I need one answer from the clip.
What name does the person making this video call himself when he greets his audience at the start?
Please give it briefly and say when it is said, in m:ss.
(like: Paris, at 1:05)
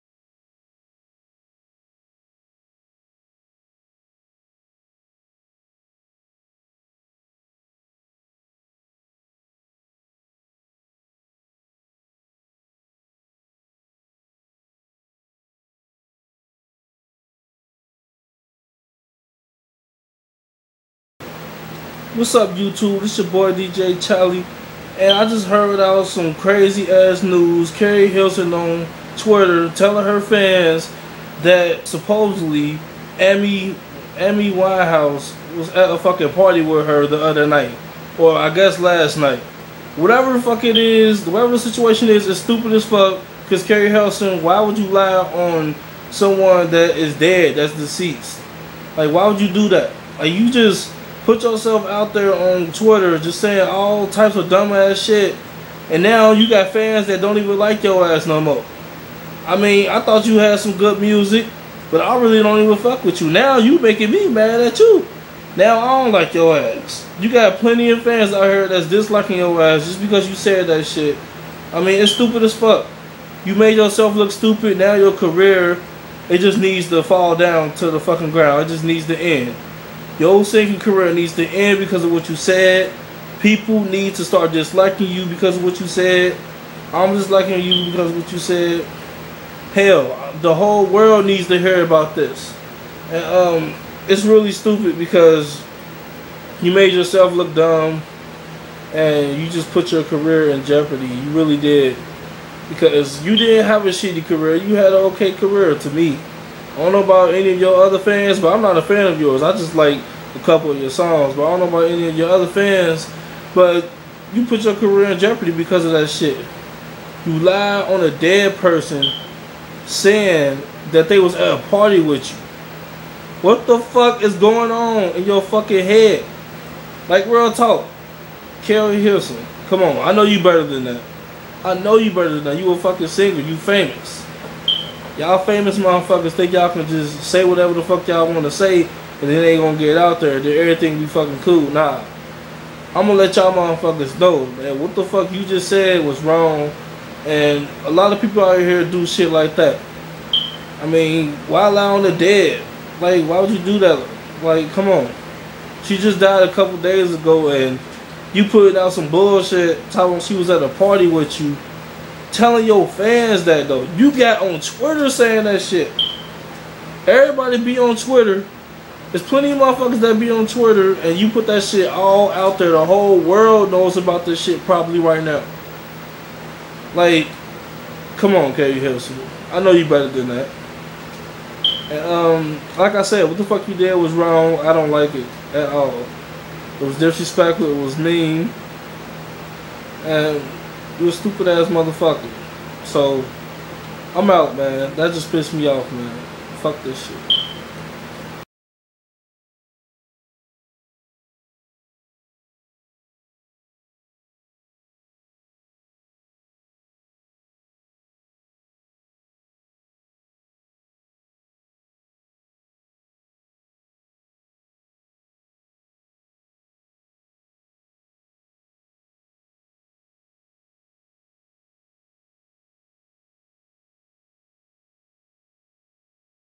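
DJ Telly, at 0:23.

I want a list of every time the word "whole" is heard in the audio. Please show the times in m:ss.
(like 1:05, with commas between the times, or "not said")
1:30, 2:52.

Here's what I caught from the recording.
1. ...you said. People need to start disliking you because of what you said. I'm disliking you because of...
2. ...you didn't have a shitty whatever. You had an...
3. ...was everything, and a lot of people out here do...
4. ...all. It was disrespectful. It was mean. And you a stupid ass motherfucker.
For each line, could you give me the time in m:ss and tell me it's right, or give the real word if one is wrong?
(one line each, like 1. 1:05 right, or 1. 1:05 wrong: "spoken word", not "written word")
1. 1:22 right
2. 1:43 wrong: "career", not "whatever"
3. 2:26 wrong: "wrong", not "everything"
4. 3:05 right.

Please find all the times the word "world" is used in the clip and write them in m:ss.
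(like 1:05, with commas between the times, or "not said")
1:30, 2:53.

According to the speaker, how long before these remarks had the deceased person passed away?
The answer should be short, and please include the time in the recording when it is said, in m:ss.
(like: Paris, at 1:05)
a couple days ago, at 2:36.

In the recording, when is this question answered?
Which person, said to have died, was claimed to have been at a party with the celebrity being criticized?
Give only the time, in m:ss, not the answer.
0:34.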